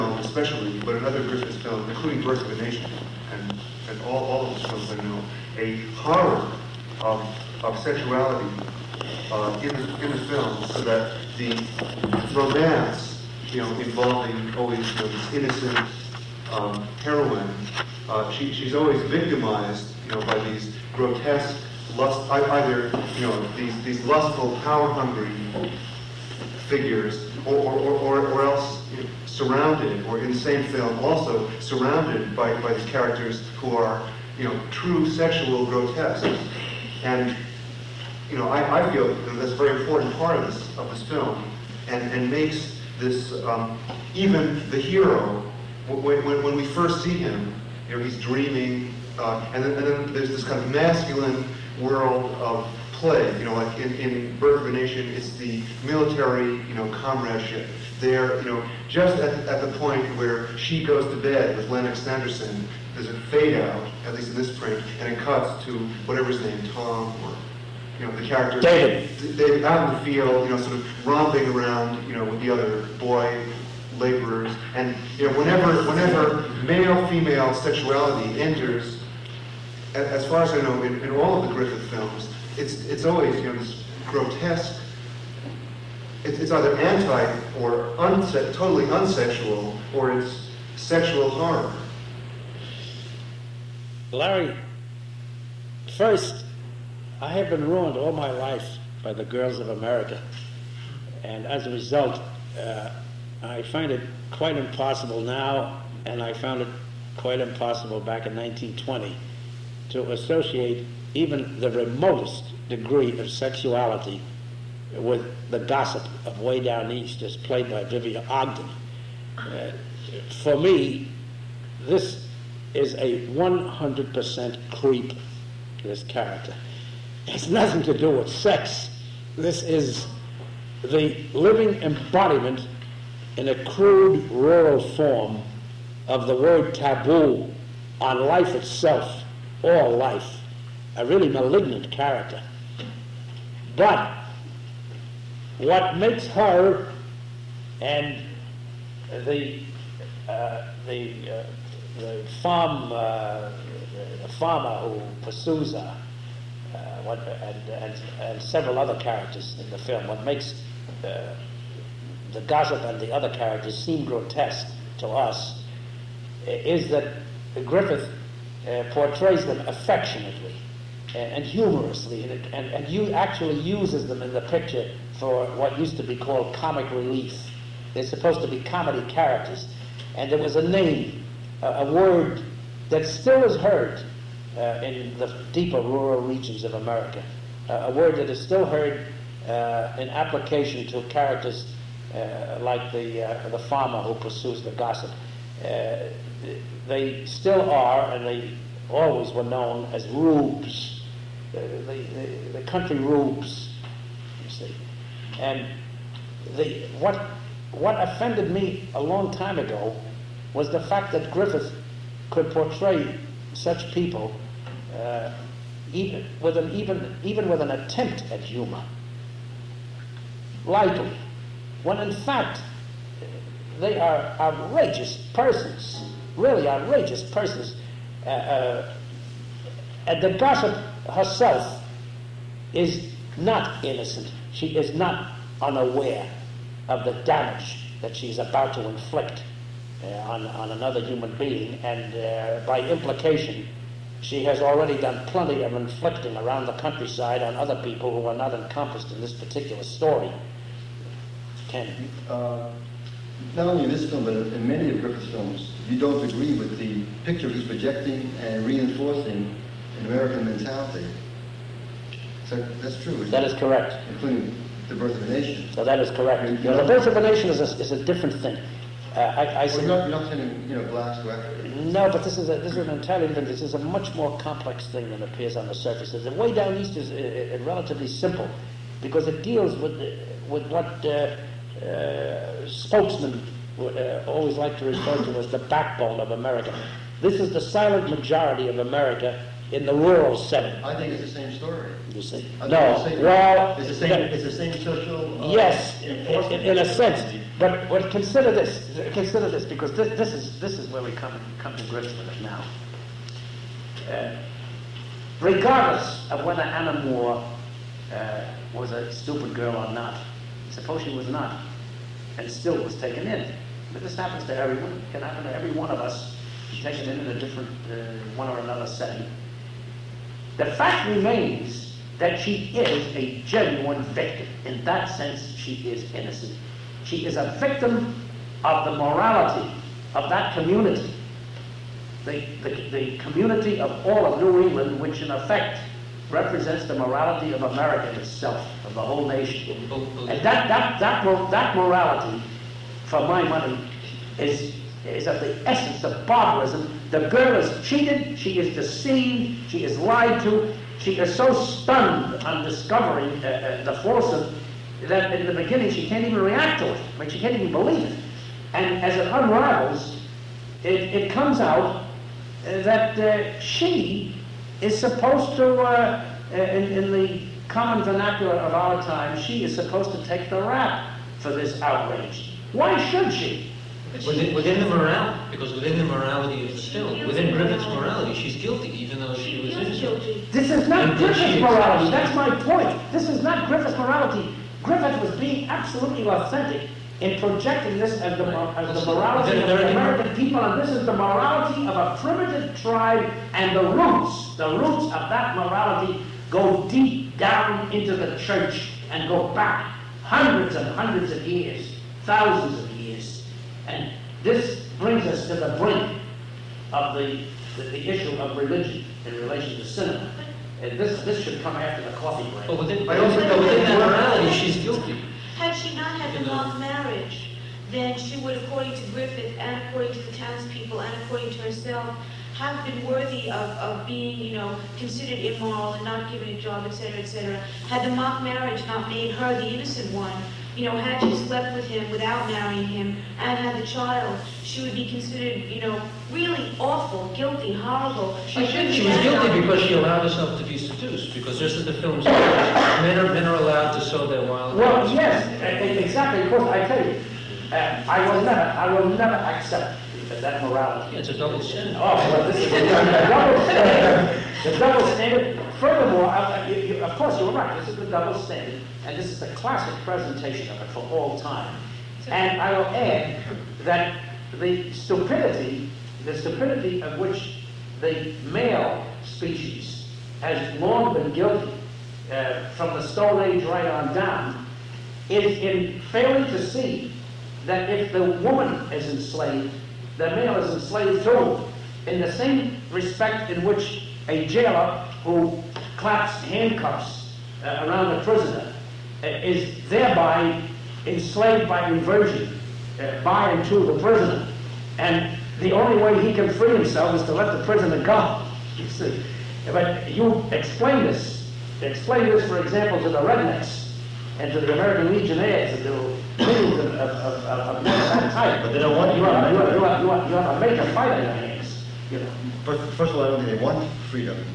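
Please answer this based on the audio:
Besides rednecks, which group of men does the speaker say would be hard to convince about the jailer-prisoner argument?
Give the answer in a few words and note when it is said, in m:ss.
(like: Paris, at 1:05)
American Legionnaires, at 8:24.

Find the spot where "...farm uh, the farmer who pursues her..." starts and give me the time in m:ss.
2:32.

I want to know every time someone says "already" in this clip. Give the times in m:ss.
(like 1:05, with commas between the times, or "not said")
4:04.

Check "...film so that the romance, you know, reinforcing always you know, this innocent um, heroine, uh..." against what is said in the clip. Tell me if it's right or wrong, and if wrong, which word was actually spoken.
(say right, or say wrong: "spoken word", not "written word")
wrong: "involving", not "reinforcing".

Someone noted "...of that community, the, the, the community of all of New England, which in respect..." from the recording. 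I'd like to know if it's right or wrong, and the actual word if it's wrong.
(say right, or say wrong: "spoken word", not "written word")
wrong: "effect", not "respect".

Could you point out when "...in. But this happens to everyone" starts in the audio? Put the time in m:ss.
5:13.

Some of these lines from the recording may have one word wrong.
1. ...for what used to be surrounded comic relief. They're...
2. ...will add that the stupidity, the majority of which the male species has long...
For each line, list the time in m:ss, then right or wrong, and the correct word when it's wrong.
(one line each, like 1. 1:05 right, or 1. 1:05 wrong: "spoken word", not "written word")
1. 2:55 wrong: "called", not "surrounded"
2. 7:42 wrong: "stupidity", not "majority".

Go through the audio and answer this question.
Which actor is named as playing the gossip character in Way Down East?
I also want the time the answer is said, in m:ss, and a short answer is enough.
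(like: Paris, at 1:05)
Vivian Ogden, at 1:57.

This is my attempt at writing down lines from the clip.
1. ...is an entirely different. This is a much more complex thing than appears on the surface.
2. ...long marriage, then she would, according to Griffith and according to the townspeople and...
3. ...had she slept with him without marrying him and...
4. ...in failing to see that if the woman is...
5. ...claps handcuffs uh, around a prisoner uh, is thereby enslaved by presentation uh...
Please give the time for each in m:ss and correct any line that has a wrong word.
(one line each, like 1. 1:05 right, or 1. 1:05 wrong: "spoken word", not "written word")
1. 4:32 right
2. 6:56 right
3. 7:10 right
4. 7:55 right
5. 8:05 wrong: "inversion", not "presentation".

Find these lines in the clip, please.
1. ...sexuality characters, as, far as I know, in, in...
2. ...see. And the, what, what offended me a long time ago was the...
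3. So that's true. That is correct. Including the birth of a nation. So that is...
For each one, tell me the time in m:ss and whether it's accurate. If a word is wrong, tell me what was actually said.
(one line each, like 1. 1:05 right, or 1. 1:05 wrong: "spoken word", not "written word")
1. 1:17 wrong: "enters", not "characters"
2. 3:24 right
3. 4:22 right.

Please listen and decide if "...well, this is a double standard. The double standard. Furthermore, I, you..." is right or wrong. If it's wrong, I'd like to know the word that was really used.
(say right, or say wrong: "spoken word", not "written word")
right.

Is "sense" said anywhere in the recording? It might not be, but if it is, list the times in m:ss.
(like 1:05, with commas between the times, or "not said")
4:56, 5:25.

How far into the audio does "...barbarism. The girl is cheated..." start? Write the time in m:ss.
5:46.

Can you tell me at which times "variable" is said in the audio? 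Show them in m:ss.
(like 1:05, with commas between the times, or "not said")
not said.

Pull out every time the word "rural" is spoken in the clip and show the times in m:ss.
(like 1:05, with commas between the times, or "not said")
2:14, 3:05, 4:49.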